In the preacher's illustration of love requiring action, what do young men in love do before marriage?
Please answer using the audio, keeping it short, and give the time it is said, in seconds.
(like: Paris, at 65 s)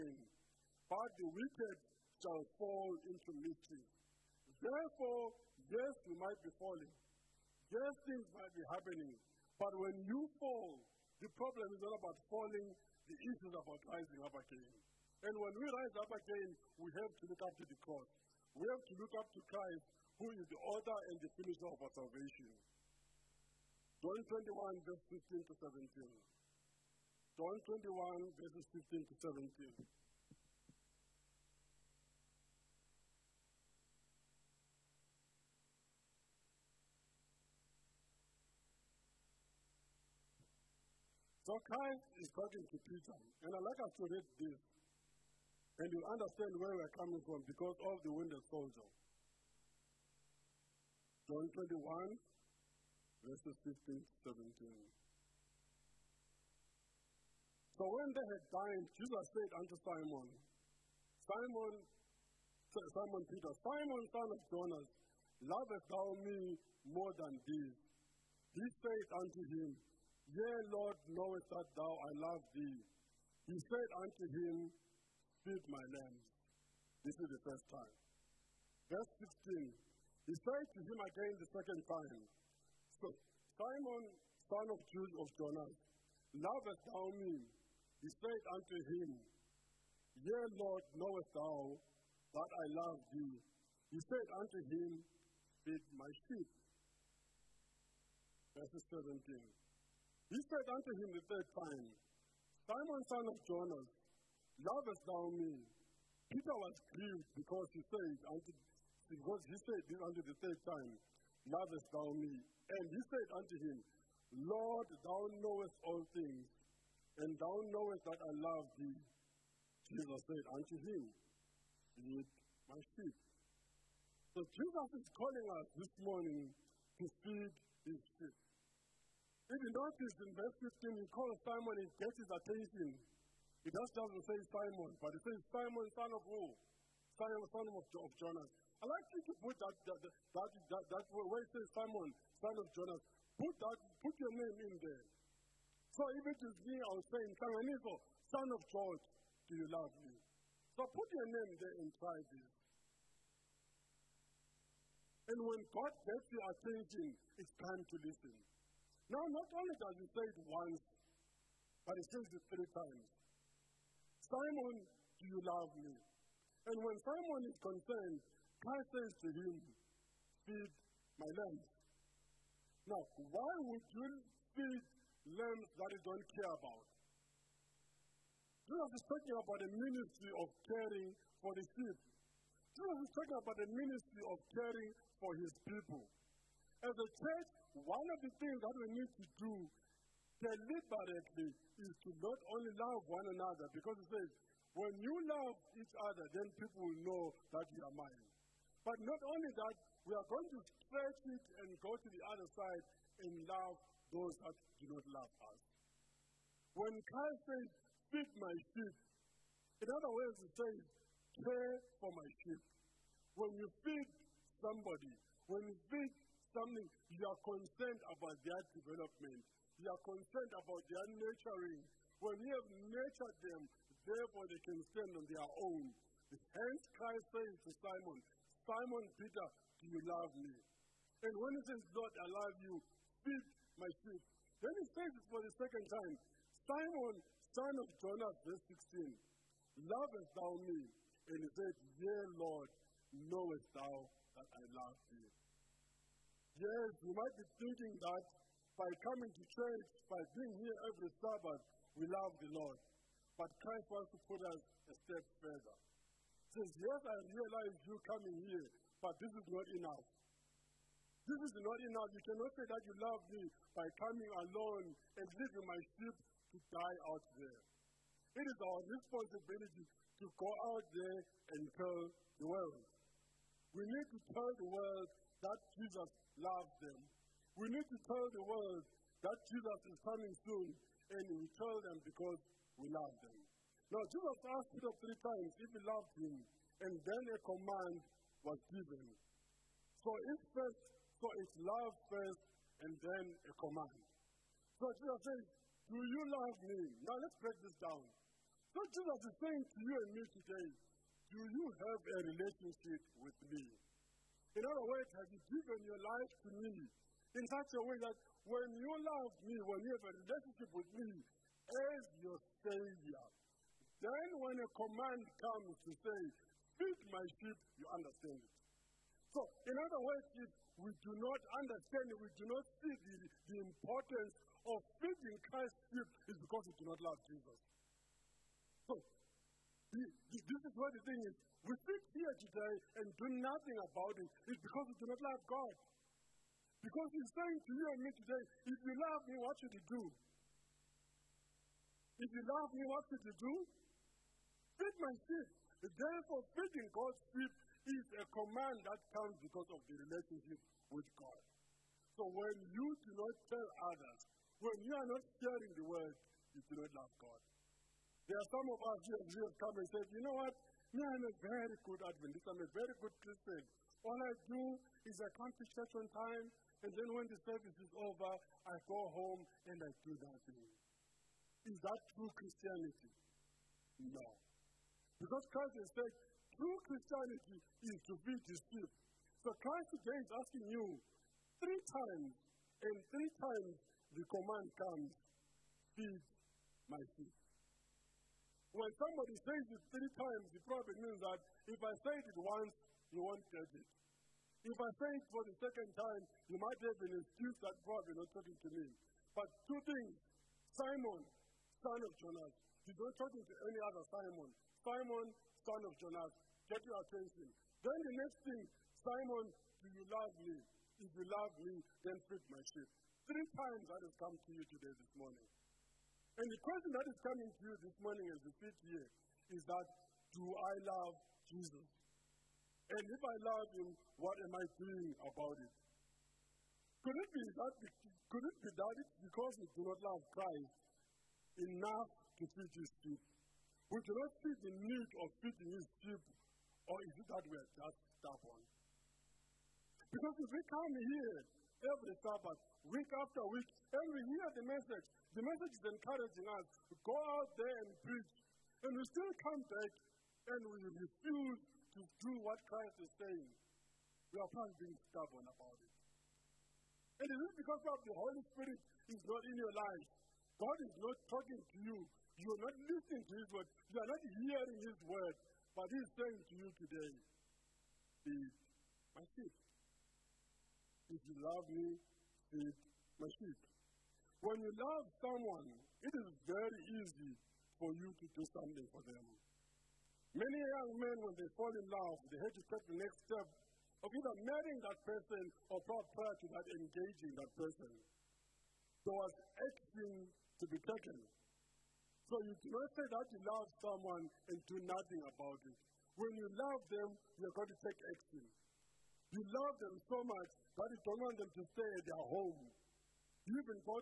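Engaging, at 486 s.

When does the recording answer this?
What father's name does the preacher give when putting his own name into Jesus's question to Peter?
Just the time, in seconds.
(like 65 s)
148 s.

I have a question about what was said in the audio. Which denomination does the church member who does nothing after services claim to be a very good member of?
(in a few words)
Adventist.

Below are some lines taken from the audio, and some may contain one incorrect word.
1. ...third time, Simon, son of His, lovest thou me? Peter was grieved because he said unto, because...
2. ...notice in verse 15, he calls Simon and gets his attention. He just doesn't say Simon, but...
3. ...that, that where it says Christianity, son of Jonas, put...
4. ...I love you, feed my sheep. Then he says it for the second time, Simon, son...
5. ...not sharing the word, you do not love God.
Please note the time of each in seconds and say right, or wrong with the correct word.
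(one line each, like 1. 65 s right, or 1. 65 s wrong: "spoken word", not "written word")
1. 101 s wrong: "Jonas", not "His"
2. 129 s right
3. 140 s wrong: "Simon", not "Christianity"
4. 232 s right
5. 355 s right.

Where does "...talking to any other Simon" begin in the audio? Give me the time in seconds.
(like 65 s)
403 s.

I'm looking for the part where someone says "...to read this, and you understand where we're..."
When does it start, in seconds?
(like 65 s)
44 s.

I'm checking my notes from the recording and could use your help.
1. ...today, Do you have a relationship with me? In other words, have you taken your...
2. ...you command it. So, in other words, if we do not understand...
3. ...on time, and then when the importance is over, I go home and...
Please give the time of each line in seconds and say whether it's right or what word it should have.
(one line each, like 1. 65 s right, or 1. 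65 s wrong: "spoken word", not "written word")
1. 300 s wrong: "given", not "taken"
2. 317 s wrong: "understand", not "command"
3. 365 s wrong: "service", not "importance".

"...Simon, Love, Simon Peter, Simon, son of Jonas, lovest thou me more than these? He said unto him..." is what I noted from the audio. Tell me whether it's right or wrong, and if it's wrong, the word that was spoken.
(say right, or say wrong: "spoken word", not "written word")
wrong: "Simon", not "Love".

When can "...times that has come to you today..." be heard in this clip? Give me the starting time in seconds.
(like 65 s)
413 s.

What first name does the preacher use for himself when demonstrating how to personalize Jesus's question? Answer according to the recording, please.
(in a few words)
Nhlanganiso.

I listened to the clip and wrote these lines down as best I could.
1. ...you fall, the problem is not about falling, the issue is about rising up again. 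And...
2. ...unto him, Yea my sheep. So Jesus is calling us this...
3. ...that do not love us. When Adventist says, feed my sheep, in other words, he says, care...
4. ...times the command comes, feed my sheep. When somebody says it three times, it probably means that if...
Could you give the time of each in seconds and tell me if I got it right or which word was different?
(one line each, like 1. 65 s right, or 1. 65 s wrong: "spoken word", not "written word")
1. 10 s right
2. 120 s wrong: "Lead", not "Yea"
3. 204 s wrong: "Christ", not "Adventist"
4. 383 s right.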